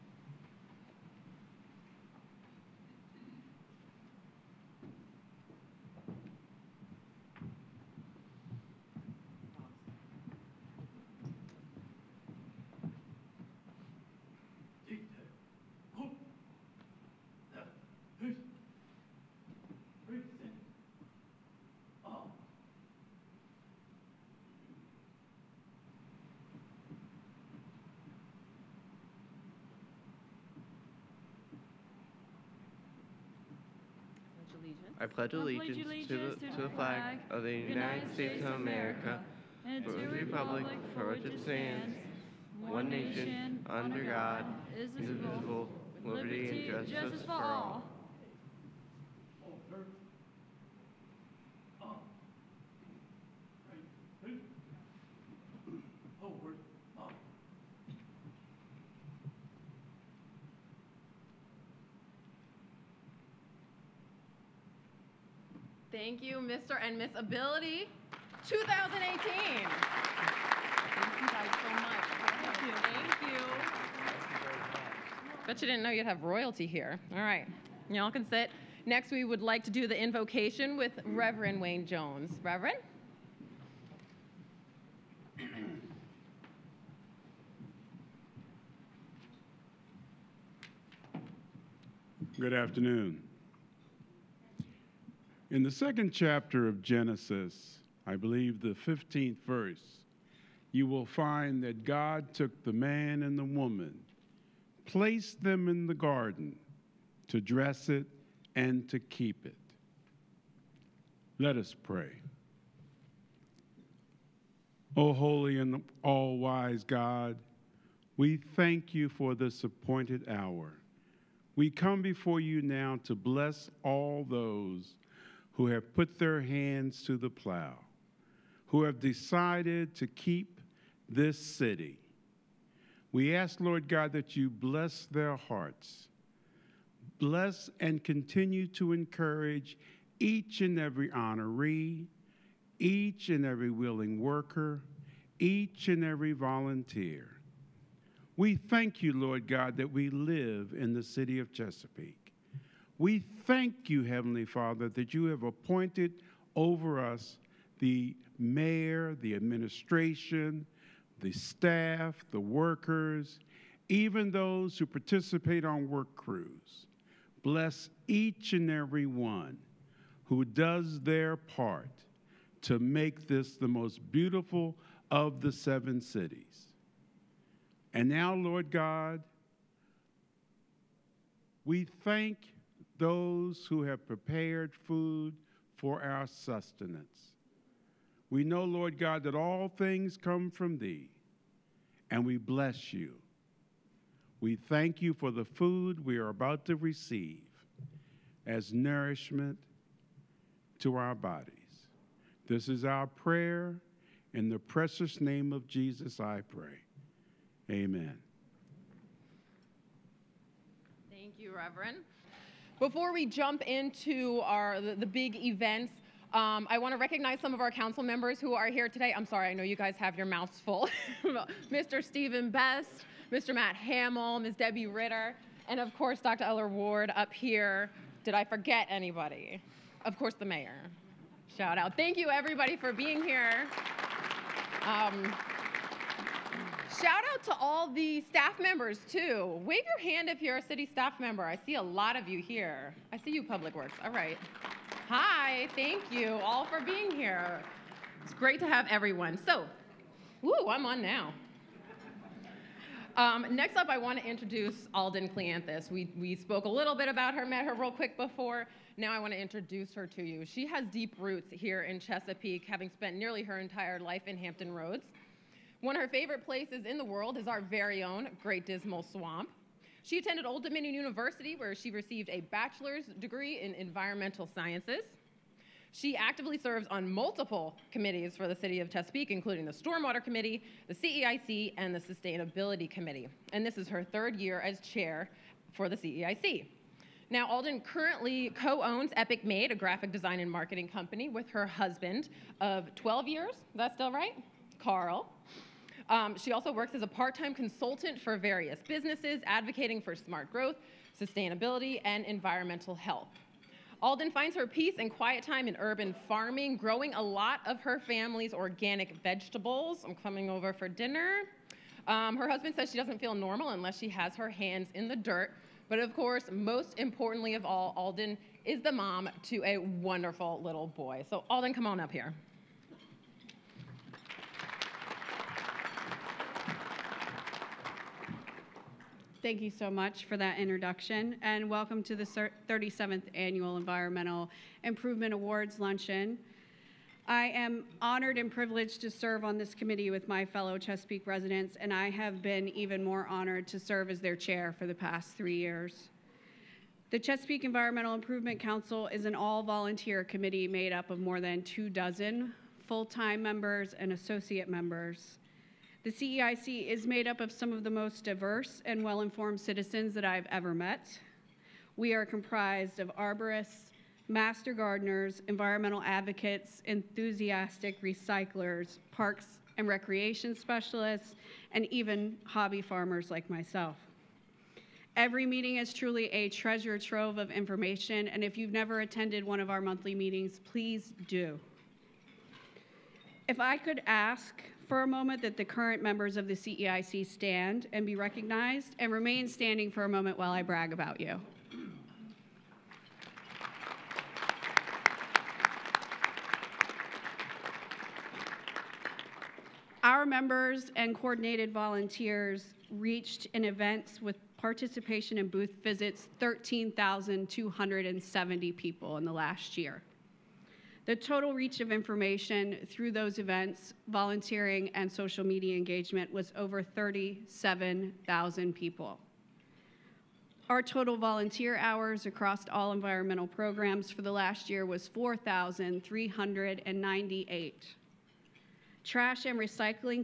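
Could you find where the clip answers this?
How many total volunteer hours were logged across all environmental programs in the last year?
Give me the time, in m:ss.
7:05.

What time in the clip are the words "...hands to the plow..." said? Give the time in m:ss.
2:06.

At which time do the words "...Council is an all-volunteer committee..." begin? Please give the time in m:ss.
5:48.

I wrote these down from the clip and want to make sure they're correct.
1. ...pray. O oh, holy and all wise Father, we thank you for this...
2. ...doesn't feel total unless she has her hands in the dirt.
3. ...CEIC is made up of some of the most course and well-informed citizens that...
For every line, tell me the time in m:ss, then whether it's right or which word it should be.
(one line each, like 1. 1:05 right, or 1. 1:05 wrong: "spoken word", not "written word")
1. 1:51 wrong: "God", not "Father"
2. 5:12 wrong: "normal", not "total"
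3. 5:56 wrong: "diverse", not "course".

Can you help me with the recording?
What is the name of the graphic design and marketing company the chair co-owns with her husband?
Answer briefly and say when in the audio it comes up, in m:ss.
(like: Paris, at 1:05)
Epic Made, at 4:49.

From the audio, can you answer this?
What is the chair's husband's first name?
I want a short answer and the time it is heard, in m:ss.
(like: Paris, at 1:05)
Carl, at 4:54.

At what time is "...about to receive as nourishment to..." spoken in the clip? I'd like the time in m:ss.
3:16.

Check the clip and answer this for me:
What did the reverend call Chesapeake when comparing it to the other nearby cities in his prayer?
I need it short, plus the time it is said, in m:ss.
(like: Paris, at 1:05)
the most beautiful of the seven cities, at 2:53.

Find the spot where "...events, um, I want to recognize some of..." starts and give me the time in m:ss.
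3:35.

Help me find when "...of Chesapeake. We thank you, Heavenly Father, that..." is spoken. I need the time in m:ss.
2:31.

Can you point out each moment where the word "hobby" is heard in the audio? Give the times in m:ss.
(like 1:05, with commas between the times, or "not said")
6:12.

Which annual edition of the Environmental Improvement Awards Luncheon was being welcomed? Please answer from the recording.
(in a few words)
37th.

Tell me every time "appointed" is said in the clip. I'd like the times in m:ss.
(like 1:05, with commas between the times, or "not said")
1:59, 2:35.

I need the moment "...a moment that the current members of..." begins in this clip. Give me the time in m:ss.
6:25.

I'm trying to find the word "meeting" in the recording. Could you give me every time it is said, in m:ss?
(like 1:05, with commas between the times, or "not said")
6:15, 6:20.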